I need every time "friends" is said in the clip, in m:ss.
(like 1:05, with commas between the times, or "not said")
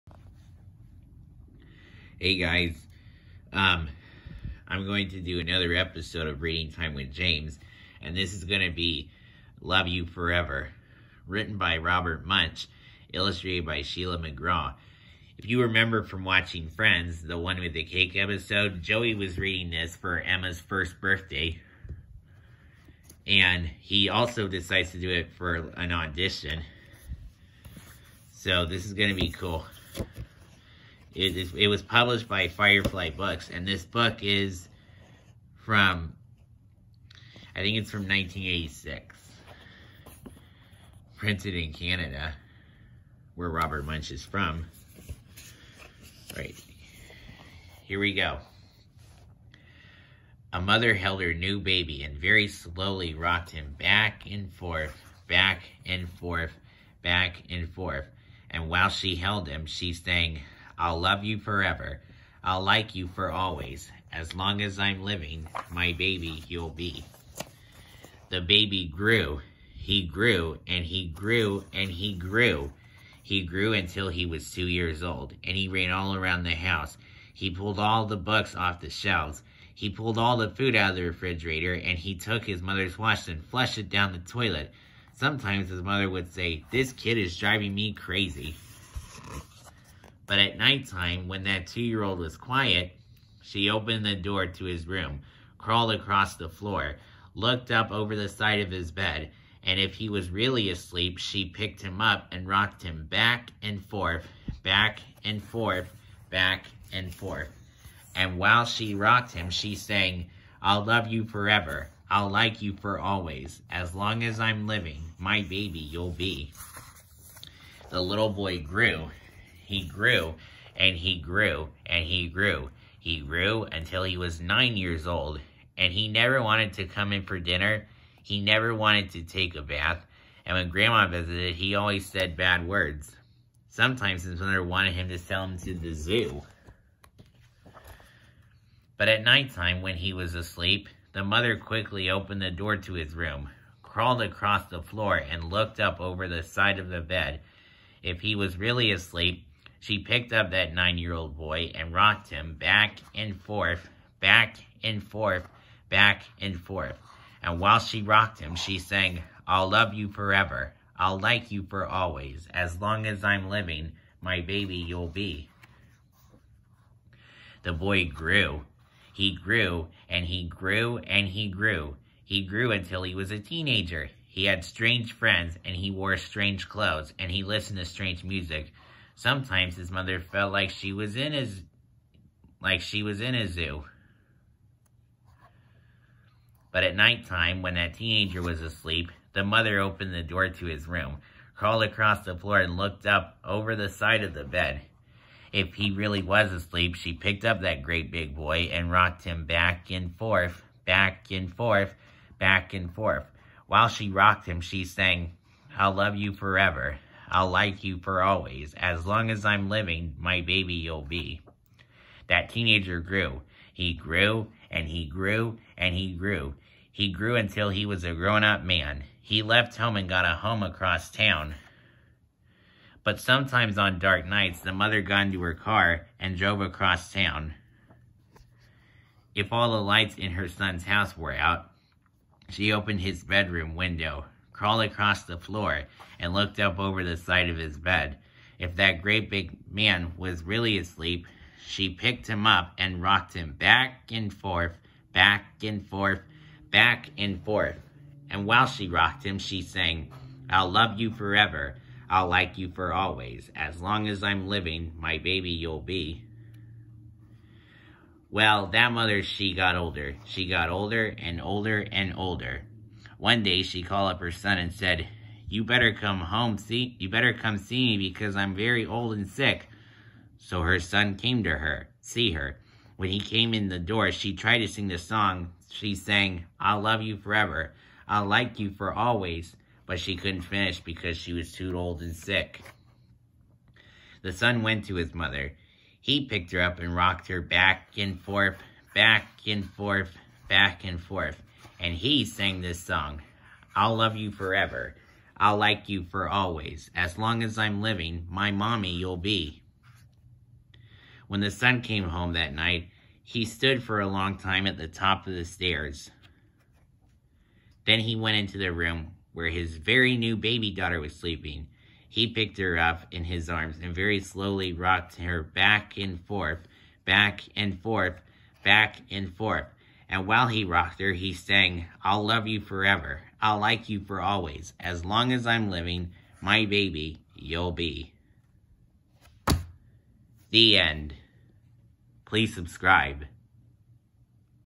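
0:16, 2:55.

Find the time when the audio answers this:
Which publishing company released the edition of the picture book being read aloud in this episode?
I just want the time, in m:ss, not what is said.
0:32.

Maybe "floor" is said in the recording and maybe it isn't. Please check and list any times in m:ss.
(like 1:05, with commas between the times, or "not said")
1:36, 2:24, 3:12, 3:55.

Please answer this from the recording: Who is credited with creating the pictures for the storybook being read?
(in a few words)
Sheila McGraw.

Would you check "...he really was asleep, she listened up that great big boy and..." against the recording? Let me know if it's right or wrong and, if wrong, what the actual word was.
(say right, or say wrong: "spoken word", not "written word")
wrong: "picked", not "listened".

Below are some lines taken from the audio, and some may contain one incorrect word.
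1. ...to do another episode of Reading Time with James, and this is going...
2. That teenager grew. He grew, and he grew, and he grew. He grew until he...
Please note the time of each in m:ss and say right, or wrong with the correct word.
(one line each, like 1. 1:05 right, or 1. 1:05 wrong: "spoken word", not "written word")
1. 0:05 right
2. 3:32 right.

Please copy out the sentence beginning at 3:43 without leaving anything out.
But sometimes on dark nights, the mother got into her car and drove across town.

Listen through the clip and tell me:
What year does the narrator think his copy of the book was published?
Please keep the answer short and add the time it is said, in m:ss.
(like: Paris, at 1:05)
1986, at 0:38.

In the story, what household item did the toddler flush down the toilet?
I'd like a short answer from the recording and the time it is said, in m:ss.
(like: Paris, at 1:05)
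his mother's wash, at 1:22.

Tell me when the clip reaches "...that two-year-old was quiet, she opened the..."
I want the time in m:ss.
1:31.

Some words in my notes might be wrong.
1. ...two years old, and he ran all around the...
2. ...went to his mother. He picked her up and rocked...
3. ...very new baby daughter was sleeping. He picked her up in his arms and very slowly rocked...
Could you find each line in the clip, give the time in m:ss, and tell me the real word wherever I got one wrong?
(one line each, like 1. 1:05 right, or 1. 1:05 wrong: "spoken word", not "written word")
1. 1:14 right
2. 4:44 right
3. 5:09 right.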